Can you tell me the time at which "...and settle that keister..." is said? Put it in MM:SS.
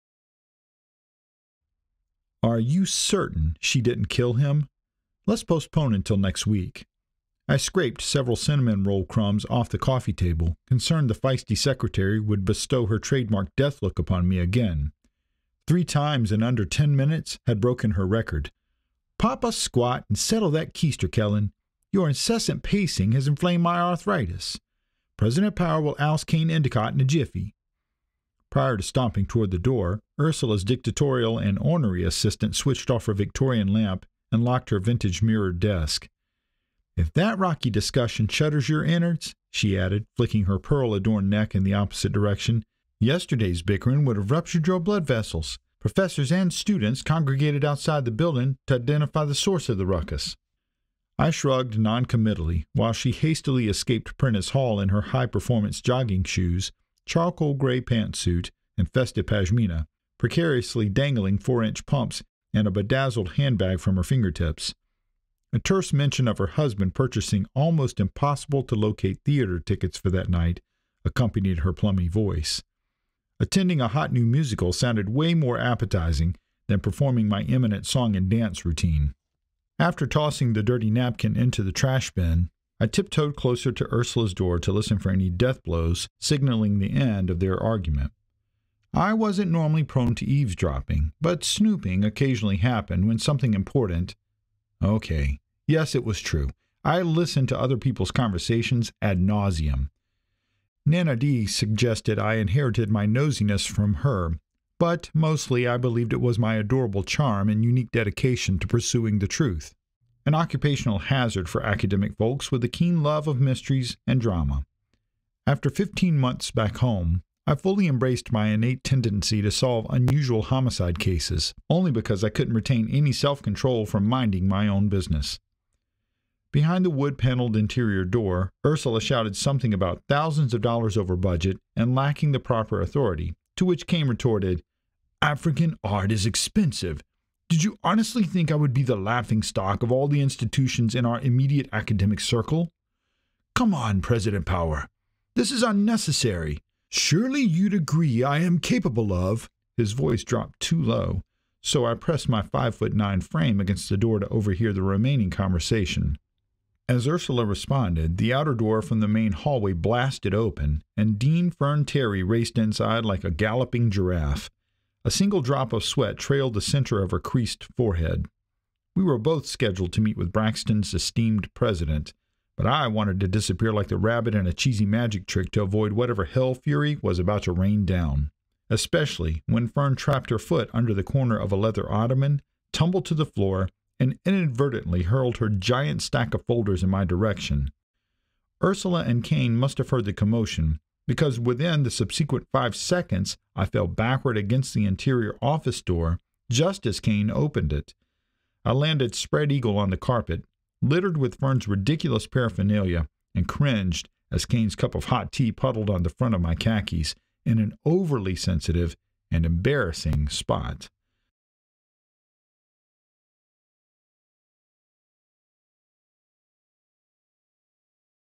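00:20.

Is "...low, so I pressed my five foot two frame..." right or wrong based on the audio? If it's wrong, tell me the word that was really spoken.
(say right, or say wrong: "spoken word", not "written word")
wrong: "nine", not "two".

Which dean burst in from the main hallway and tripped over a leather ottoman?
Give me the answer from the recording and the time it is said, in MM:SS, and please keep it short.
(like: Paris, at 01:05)
Fern Terry, at 02:41.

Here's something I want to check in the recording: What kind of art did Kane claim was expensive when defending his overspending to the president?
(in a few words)
African art.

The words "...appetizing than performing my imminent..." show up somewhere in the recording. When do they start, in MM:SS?
01:15.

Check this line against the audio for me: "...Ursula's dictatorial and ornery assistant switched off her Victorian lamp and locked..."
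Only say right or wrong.
right.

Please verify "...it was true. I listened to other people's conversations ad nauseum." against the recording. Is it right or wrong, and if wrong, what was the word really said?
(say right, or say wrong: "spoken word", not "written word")
right.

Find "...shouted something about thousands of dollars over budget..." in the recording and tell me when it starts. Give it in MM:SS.
02:09.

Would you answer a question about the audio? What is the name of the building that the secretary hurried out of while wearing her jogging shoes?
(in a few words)
Prentice Hall.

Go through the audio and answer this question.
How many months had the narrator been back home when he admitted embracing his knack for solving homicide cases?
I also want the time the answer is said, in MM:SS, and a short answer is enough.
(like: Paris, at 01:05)
15, at 01:55.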